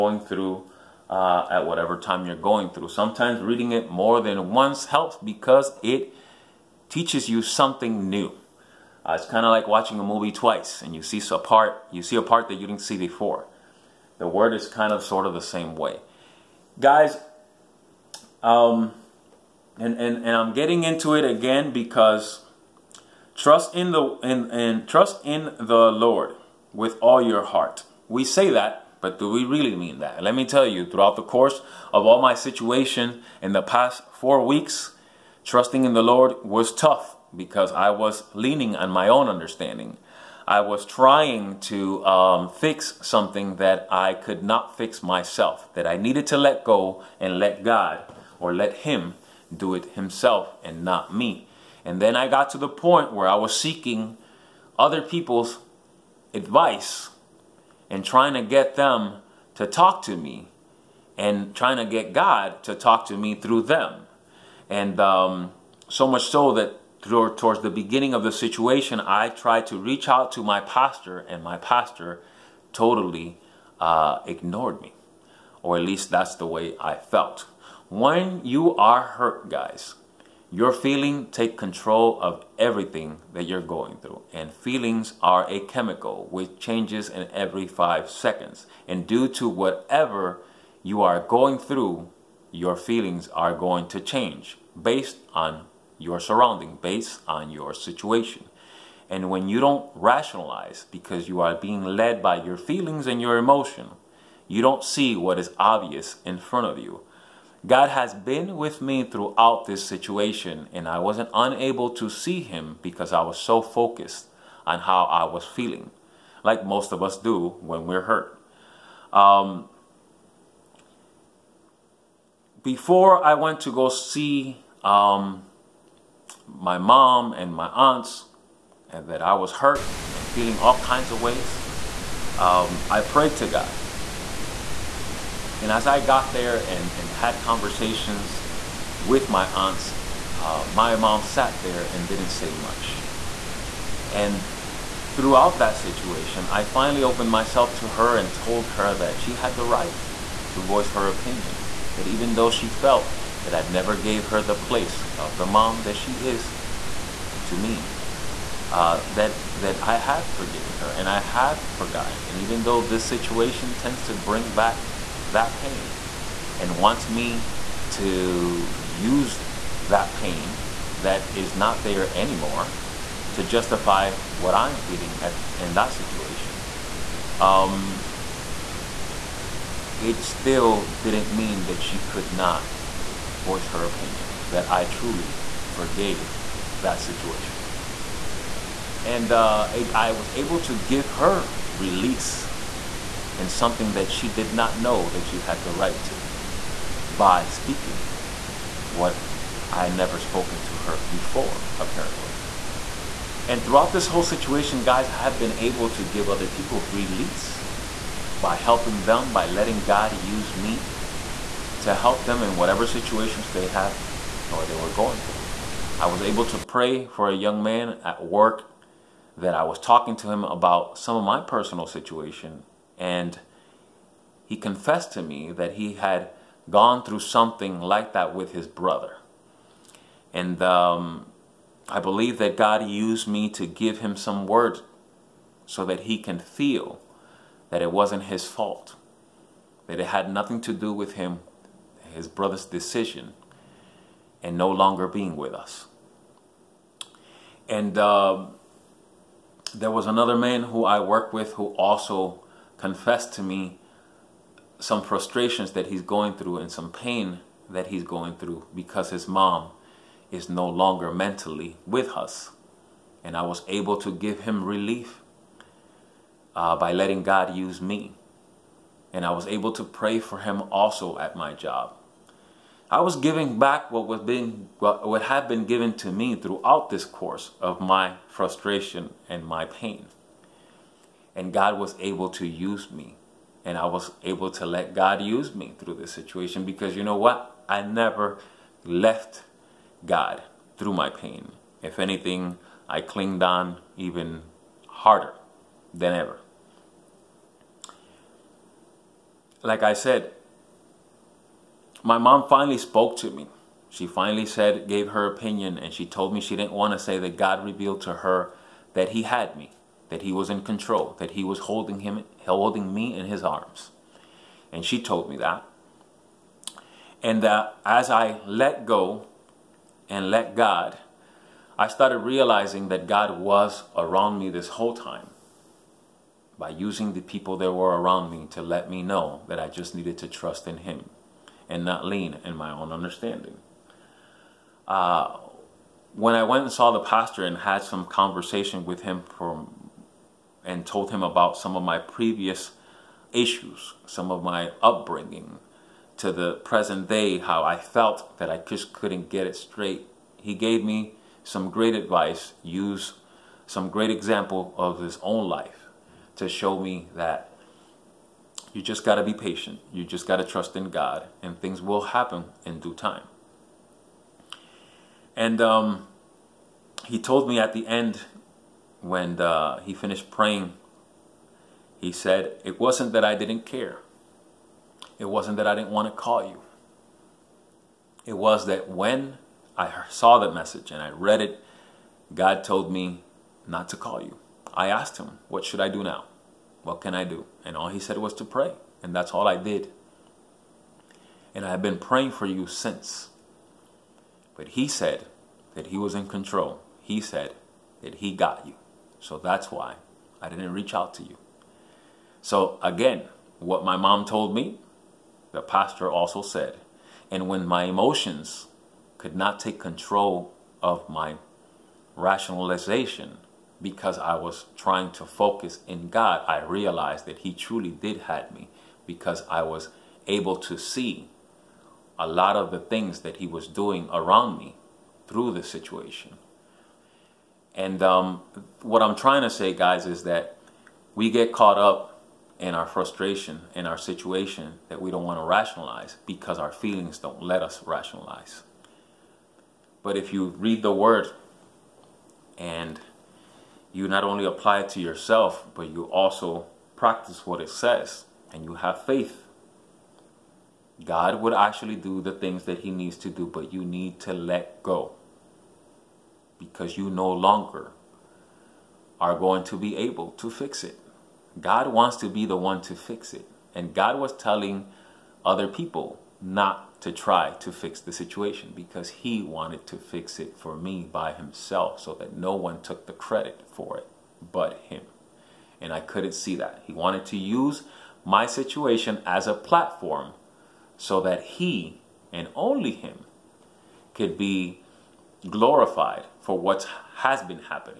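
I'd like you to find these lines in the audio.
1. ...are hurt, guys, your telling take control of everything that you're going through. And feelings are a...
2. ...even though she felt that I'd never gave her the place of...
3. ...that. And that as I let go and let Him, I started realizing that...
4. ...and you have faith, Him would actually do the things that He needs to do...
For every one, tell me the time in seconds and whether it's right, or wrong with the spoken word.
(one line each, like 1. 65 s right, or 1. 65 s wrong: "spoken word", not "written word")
1. 78 s wrong: "feeling", not "telling"
2. 152 s right
3. 315 s wrong: "God", not "Him"
4. 448 s wrong: "God", not "Him".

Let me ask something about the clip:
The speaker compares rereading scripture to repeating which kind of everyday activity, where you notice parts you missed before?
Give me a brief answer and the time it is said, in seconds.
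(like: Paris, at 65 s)
Watching a movie twice, at 9 s.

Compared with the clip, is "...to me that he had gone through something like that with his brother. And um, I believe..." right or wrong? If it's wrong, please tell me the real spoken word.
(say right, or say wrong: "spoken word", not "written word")
right.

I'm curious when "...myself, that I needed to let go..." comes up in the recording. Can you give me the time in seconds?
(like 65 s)
45 s.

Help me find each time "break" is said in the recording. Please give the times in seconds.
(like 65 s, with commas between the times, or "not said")
not said.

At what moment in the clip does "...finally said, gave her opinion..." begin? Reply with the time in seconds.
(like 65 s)
304 s.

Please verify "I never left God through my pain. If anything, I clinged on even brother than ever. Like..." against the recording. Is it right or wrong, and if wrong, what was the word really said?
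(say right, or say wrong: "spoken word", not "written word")
wrong: "harder", not "brother".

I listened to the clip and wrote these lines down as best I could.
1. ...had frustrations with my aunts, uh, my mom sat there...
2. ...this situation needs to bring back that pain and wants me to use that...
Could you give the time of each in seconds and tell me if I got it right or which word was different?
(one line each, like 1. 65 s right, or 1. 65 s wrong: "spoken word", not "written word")
1. 137 s wrong: "conversations", not "frustrations"
2. 162 s wrong: "tends", not "needs".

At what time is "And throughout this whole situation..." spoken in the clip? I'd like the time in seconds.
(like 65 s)
203 s.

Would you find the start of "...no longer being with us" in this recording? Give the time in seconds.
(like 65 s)
244 s.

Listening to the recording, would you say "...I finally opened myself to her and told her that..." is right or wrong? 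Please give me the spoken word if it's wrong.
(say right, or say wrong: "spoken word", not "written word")
right.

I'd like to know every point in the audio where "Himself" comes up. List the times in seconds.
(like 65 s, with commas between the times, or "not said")
49 s, 471 s.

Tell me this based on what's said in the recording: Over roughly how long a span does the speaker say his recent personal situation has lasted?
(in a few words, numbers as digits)
4 weeks.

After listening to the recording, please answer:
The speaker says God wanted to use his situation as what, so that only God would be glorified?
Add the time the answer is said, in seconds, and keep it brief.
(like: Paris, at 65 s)
A platform, at 479 s.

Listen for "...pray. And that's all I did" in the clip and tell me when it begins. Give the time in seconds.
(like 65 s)
388 s.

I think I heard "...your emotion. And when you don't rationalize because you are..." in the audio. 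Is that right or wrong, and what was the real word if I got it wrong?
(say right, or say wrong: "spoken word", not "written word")
wrong: "situation", not "emotion".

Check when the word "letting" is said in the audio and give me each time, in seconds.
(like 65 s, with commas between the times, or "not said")
209 s, 266 s.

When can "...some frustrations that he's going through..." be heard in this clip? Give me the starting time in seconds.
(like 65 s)
254 s.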